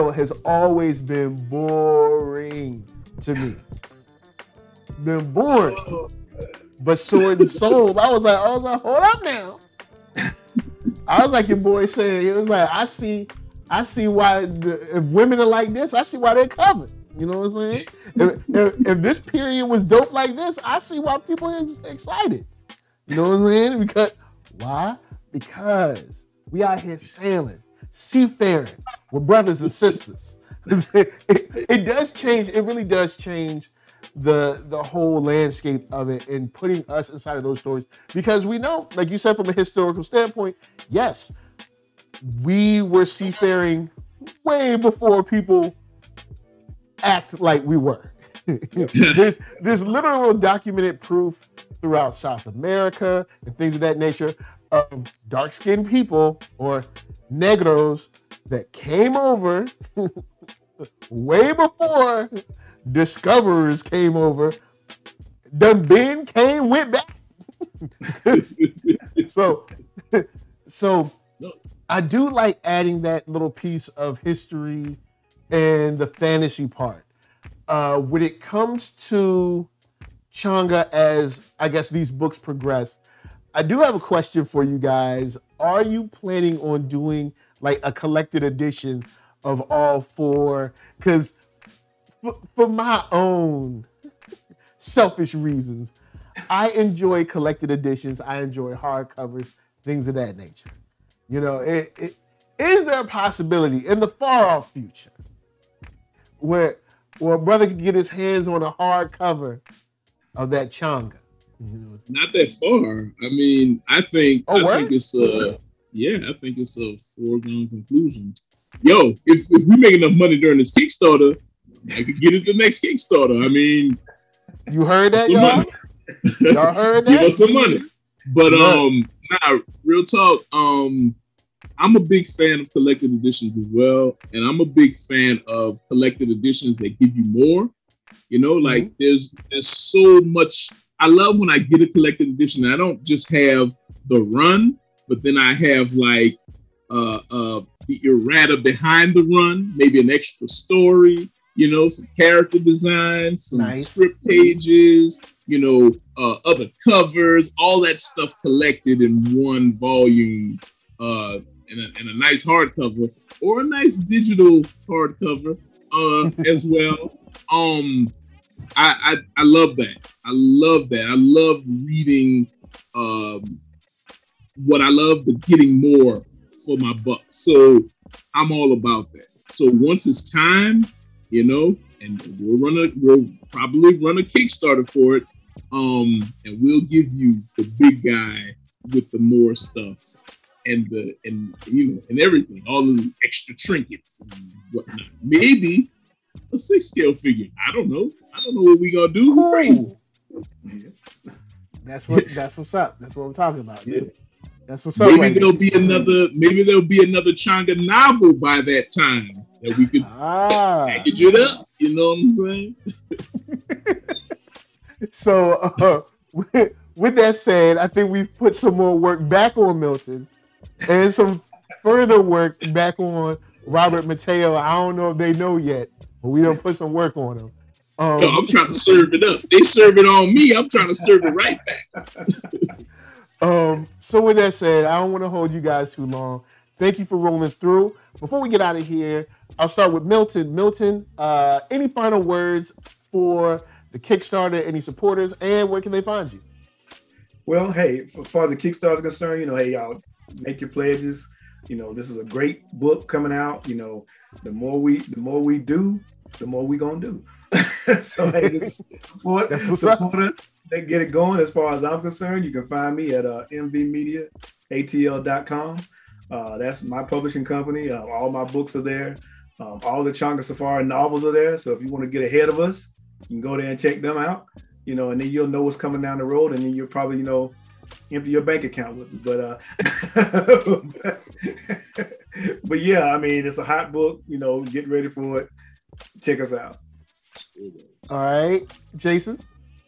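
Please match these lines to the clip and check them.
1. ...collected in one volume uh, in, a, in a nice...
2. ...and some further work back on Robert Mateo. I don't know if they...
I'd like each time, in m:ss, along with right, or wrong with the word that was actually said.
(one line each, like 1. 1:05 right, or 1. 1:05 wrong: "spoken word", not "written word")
1. 2:38 right
2. 3:40 right.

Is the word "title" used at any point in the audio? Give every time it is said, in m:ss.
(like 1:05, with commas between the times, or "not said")
not said.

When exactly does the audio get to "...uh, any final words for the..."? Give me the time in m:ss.
4:01.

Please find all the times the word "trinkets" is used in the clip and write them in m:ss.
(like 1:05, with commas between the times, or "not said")
3:13.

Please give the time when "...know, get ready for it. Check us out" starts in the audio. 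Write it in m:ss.
4:44.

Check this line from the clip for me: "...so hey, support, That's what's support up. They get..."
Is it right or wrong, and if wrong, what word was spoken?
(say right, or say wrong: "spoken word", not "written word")
right.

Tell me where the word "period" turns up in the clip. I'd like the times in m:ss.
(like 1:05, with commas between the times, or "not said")
0:19.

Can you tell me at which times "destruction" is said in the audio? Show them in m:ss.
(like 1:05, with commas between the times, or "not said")
not said.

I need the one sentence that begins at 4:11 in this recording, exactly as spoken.
You know, this is a great book coming out.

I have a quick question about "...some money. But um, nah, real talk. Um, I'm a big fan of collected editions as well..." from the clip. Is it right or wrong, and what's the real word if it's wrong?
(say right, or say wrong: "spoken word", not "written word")
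right.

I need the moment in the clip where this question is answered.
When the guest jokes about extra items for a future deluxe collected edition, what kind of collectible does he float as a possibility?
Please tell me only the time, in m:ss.
3:16.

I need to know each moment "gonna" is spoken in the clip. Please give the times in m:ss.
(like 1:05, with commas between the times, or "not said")
3:18, 4:16.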